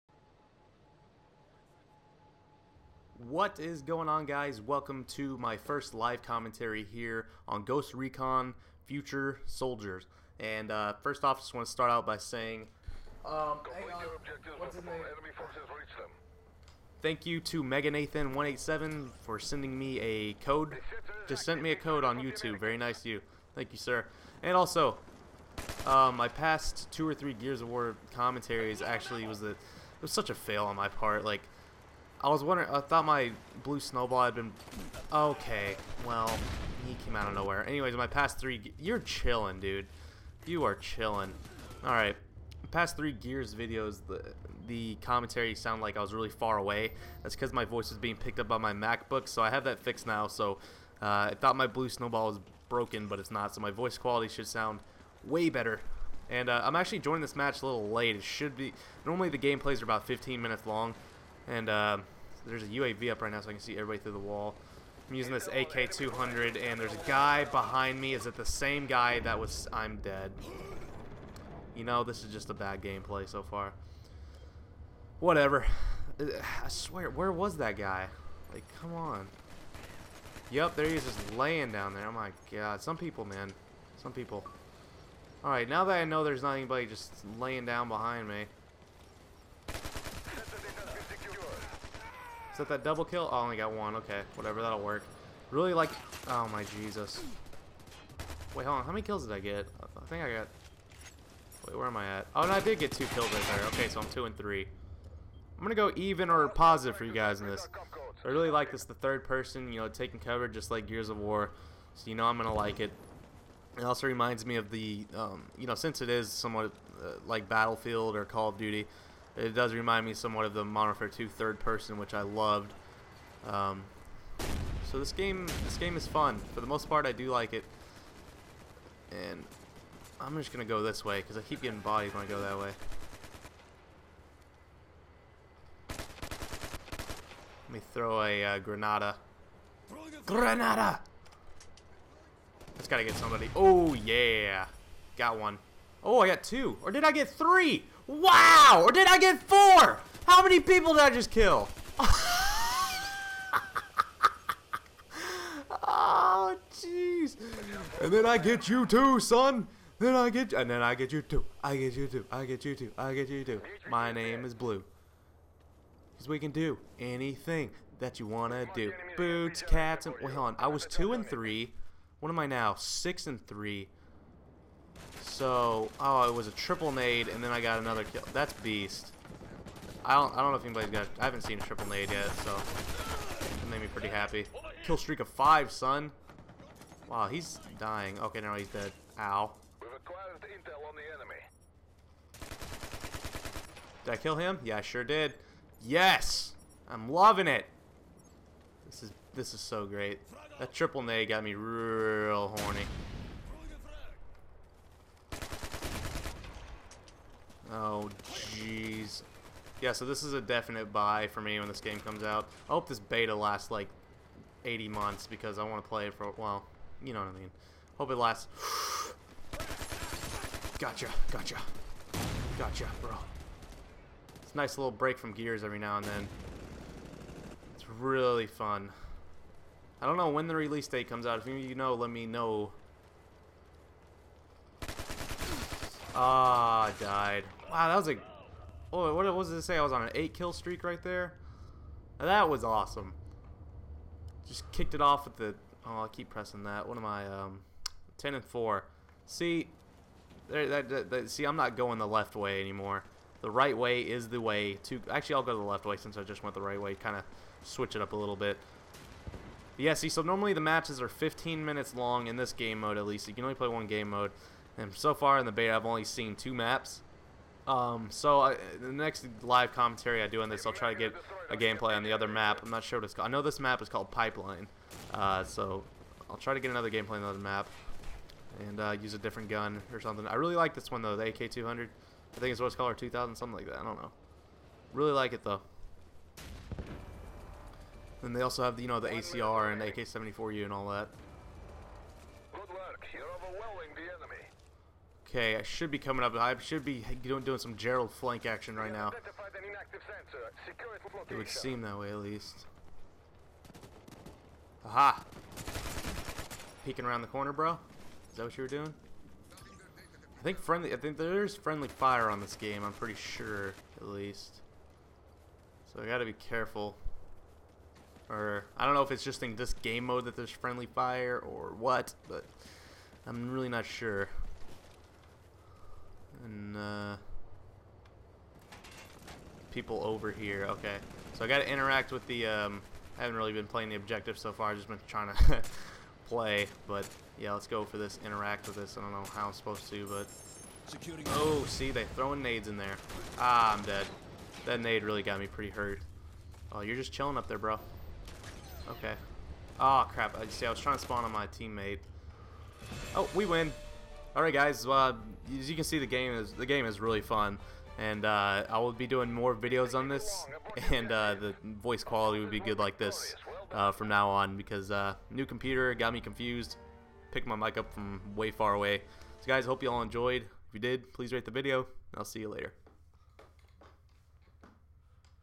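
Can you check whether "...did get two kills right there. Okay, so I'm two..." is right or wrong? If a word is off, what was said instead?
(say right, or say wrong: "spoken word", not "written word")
right.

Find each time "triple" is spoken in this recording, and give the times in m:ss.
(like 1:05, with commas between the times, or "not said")
2:56, 3:01, 3:20.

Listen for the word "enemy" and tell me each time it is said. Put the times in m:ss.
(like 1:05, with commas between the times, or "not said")
3:11, 4:54.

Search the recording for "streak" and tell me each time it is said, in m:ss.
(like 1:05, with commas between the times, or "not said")
3:04, 4:00.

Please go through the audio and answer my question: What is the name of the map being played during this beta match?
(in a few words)
Pipeline.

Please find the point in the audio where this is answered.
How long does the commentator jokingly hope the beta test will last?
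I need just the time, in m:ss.
3:34.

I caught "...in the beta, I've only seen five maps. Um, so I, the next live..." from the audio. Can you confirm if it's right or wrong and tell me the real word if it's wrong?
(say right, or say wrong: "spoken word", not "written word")
wrong: "two", not "five".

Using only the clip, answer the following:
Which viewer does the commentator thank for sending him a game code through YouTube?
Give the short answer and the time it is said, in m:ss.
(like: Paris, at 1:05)
Mega Nathan 187, at 0:17.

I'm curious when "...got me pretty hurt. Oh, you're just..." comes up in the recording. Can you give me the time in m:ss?
5:45.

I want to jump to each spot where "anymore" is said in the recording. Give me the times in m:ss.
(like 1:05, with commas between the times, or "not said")
4:12.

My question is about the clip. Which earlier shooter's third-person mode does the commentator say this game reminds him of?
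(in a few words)
Modern Warfare 2.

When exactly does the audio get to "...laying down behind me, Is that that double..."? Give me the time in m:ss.
1:27.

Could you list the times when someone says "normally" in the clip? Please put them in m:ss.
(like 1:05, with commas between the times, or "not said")
0:59, 4:20.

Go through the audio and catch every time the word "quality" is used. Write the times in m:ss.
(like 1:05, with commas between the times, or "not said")
0:53, 6:02.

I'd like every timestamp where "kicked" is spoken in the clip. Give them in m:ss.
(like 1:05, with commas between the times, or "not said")
4:04.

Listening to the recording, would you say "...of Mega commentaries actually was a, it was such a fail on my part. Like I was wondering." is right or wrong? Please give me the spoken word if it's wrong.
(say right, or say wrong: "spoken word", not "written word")
wrong: "War", not "Mega".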